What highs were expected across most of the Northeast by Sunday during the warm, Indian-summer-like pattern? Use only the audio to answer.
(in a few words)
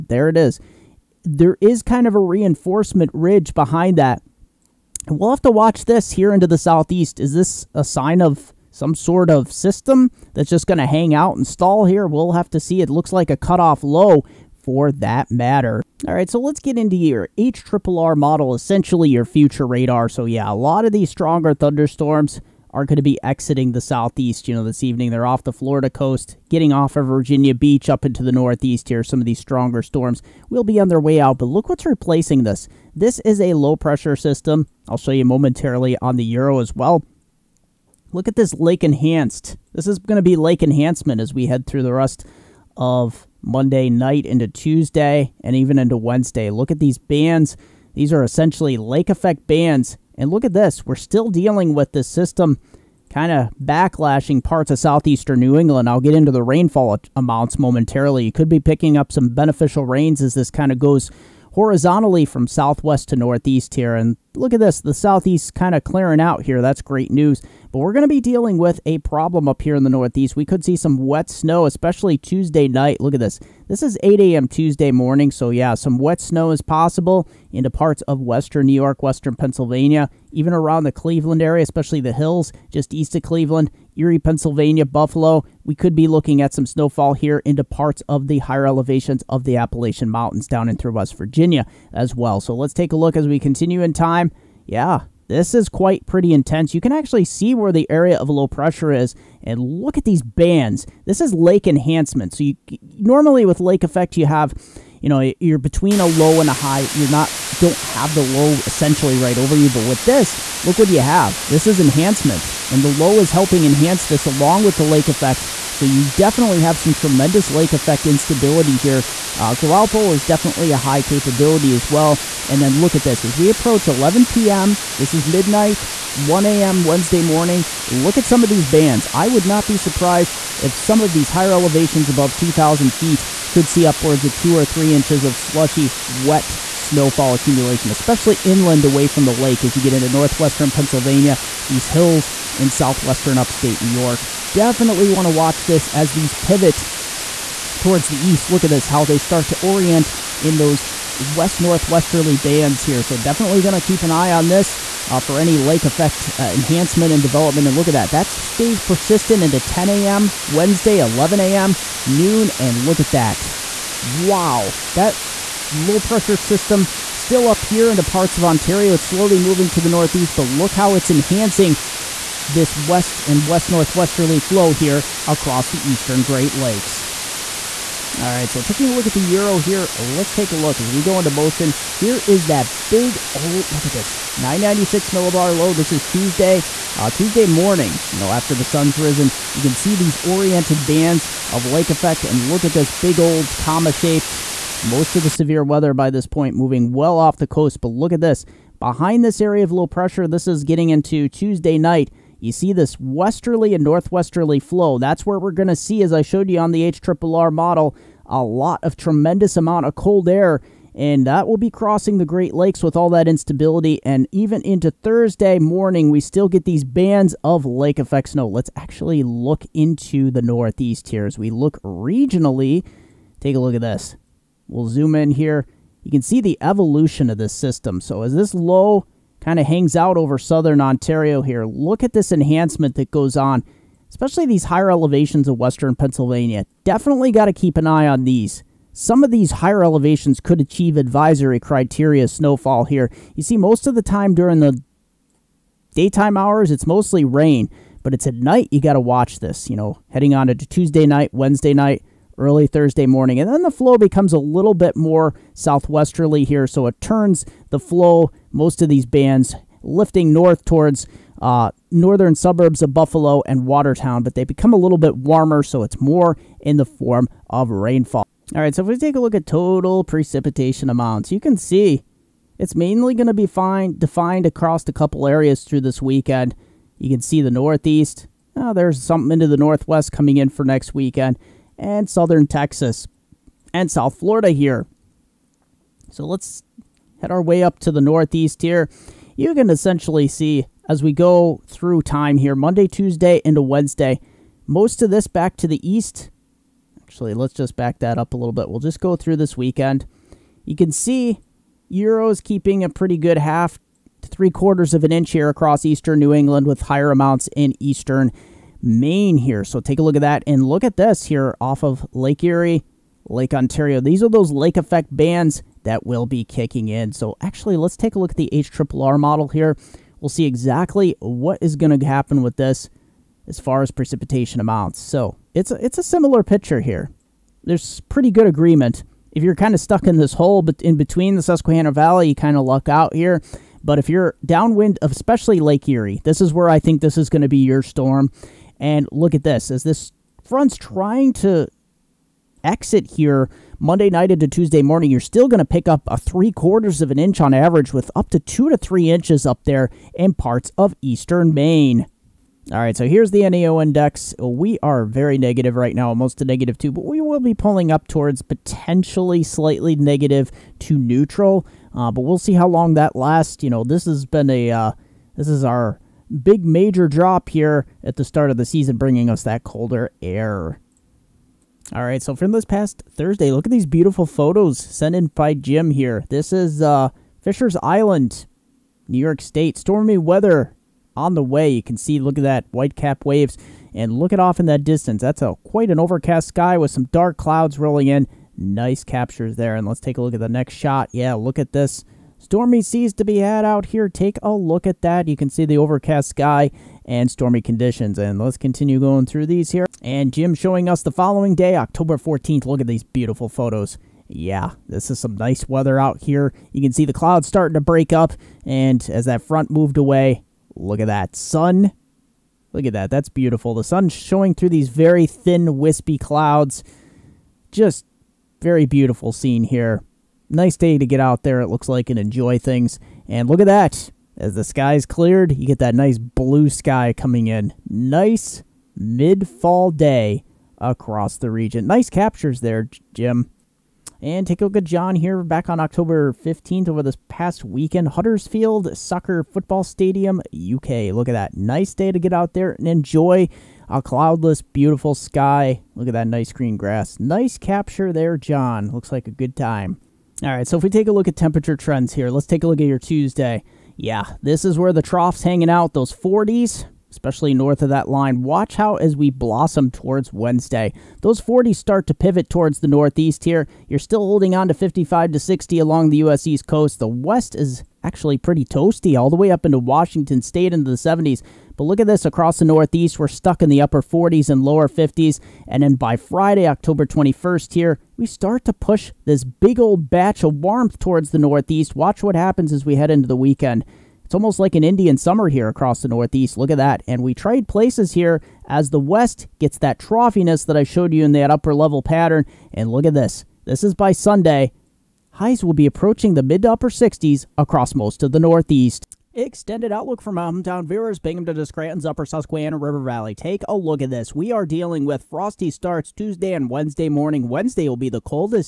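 mid to upper 60s.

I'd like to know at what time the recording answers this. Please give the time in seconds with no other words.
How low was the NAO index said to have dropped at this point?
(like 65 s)
356 s.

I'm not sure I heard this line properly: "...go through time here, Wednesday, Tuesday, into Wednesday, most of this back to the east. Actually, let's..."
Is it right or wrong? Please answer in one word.
wrong.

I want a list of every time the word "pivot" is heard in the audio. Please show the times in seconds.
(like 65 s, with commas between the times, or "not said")
146 s, 462 s.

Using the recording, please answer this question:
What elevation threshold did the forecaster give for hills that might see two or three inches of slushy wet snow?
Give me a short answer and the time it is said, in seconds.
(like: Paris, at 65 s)
2,000 feet, at 132 s.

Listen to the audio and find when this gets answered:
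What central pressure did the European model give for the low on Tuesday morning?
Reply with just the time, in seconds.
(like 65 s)
184 s.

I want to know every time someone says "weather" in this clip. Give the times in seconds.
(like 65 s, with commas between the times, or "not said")
195 s, 380 s, 405 s.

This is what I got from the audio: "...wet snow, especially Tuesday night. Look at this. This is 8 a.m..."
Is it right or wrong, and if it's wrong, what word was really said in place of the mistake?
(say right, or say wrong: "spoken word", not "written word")
right.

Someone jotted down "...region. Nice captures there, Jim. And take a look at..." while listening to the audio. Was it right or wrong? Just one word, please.
right.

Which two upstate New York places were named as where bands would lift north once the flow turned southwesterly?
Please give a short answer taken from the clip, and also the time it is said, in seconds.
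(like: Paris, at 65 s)
Buffalo and Watertown, at 262 s.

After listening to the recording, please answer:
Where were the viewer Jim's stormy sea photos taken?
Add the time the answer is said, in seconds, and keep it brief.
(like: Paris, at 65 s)
Fisher's Island, New York, at 377 s.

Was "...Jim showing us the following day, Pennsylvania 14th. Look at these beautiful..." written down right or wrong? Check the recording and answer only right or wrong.
wrong.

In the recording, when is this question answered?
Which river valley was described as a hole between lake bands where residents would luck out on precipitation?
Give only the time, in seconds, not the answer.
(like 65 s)
331 s.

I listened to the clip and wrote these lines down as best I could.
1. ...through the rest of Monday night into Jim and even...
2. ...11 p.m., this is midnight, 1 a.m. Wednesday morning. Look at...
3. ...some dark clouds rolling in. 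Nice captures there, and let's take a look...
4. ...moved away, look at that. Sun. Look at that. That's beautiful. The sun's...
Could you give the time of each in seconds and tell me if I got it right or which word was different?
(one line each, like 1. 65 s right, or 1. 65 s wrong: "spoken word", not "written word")
1. 41 s wrong: "Tuesday", not "Jim"
2. 123 s right
3. 386 s right
4. 409 s right.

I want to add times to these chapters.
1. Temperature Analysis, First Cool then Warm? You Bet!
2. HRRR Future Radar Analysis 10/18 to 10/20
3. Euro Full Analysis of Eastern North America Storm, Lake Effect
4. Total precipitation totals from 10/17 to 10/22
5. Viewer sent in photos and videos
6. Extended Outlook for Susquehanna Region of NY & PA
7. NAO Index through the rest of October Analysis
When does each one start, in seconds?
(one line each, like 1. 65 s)
1. 449 s
2. 15 s
3. 177 s
4. 268 s
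5. 371 s
6. 498 s
7. 352 s.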